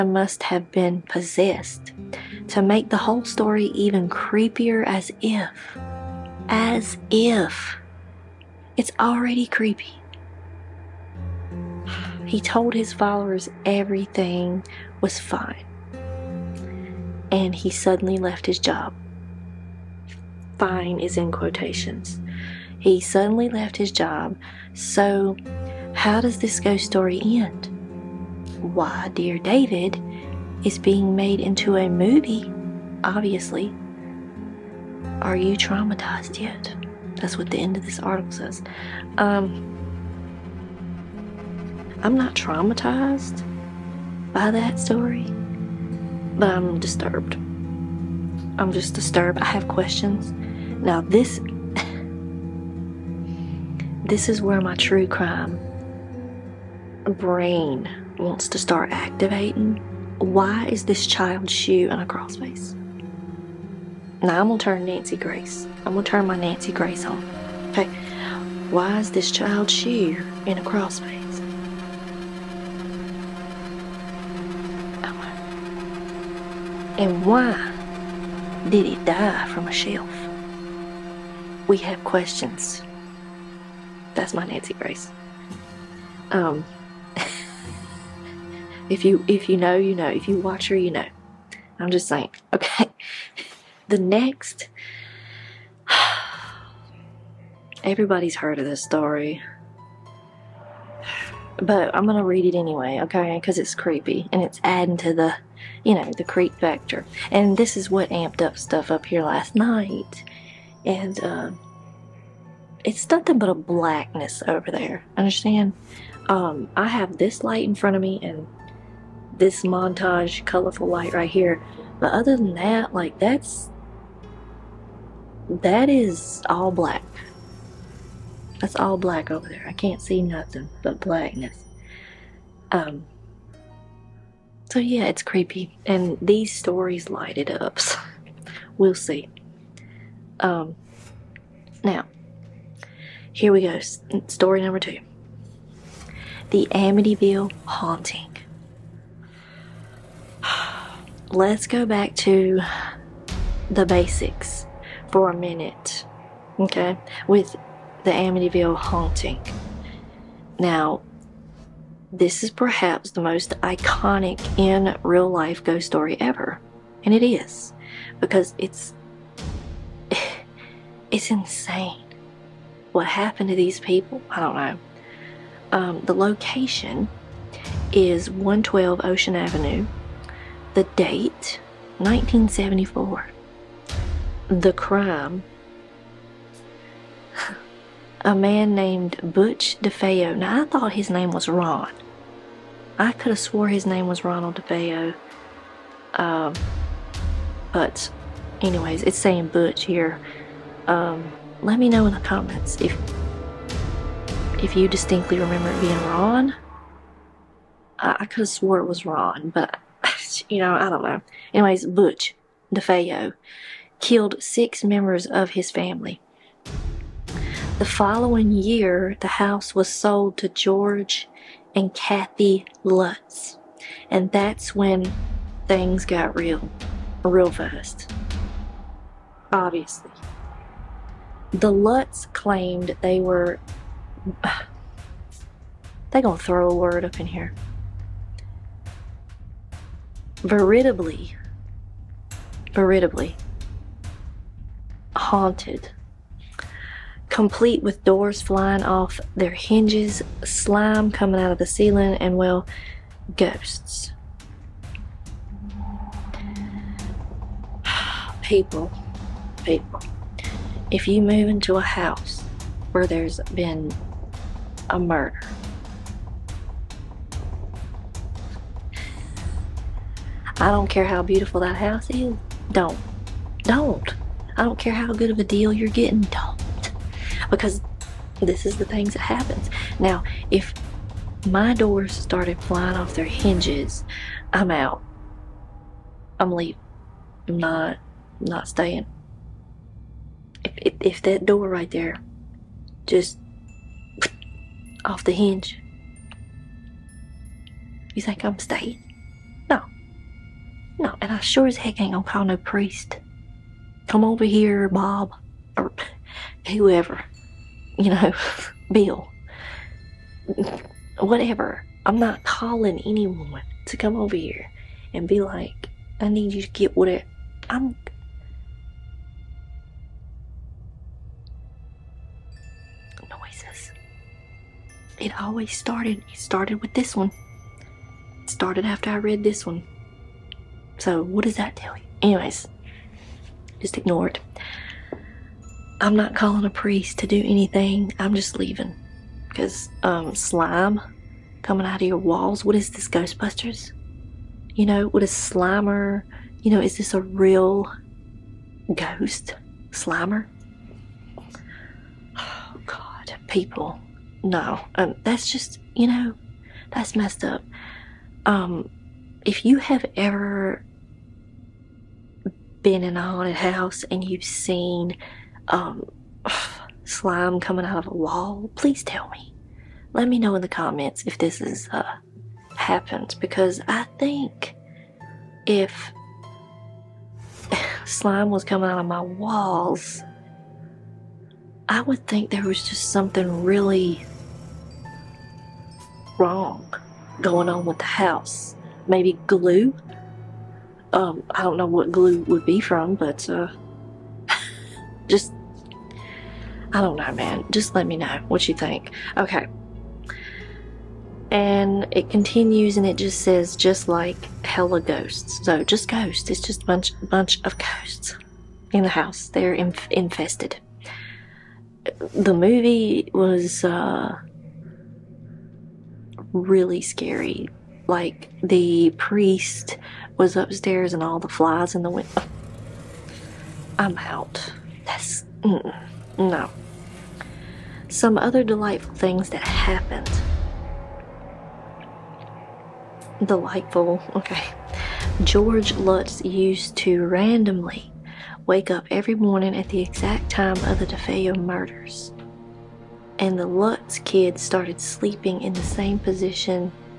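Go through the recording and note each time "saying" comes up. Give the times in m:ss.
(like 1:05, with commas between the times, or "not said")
1:32, 3:19.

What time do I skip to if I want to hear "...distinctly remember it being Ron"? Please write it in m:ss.
3:24.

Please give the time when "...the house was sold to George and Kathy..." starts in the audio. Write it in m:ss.
3:39.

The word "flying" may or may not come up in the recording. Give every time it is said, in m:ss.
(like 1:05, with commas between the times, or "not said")
4:08, 4:42.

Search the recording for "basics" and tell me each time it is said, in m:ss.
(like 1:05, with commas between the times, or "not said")
2:33.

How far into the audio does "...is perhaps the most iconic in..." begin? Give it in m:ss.
2:42.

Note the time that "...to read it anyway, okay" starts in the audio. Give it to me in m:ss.
1:42.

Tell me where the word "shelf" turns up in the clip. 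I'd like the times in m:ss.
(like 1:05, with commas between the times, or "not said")
1:19.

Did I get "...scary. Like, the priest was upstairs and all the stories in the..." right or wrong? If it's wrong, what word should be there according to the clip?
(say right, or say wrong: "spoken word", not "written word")
wrong: "flies", not "stories".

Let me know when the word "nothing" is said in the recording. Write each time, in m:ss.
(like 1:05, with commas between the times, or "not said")
1:53, 2:10.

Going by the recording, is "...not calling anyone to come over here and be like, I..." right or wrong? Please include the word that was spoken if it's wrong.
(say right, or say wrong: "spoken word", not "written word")
right.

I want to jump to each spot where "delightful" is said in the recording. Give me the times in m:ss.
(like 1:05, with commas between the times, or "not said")
7:08, 7:13.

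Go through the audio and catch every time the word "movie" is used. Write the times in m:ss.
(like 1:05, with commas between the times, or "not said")
0:31, 6:52.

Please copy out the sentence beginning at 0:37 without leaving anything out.
That's what the end of this article says.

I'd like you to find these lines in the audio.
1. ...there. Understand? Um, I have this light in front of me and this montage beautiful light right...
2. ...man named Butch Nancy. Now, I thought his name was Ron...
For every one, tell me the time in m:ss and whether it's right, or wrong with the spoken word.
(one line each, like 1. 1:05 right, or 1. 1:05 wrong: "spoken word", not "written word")
1. 1:54 wrong: "colorful", not "beautiful"
2. 3:08 wrong: "DeFeo", not "Nancy".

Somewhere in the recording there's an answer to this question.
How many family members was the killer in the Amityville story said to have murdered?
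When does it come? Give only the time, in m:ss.
3:34.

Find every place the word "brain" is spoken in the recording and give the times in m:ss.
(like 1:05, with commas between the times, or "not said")
0:57.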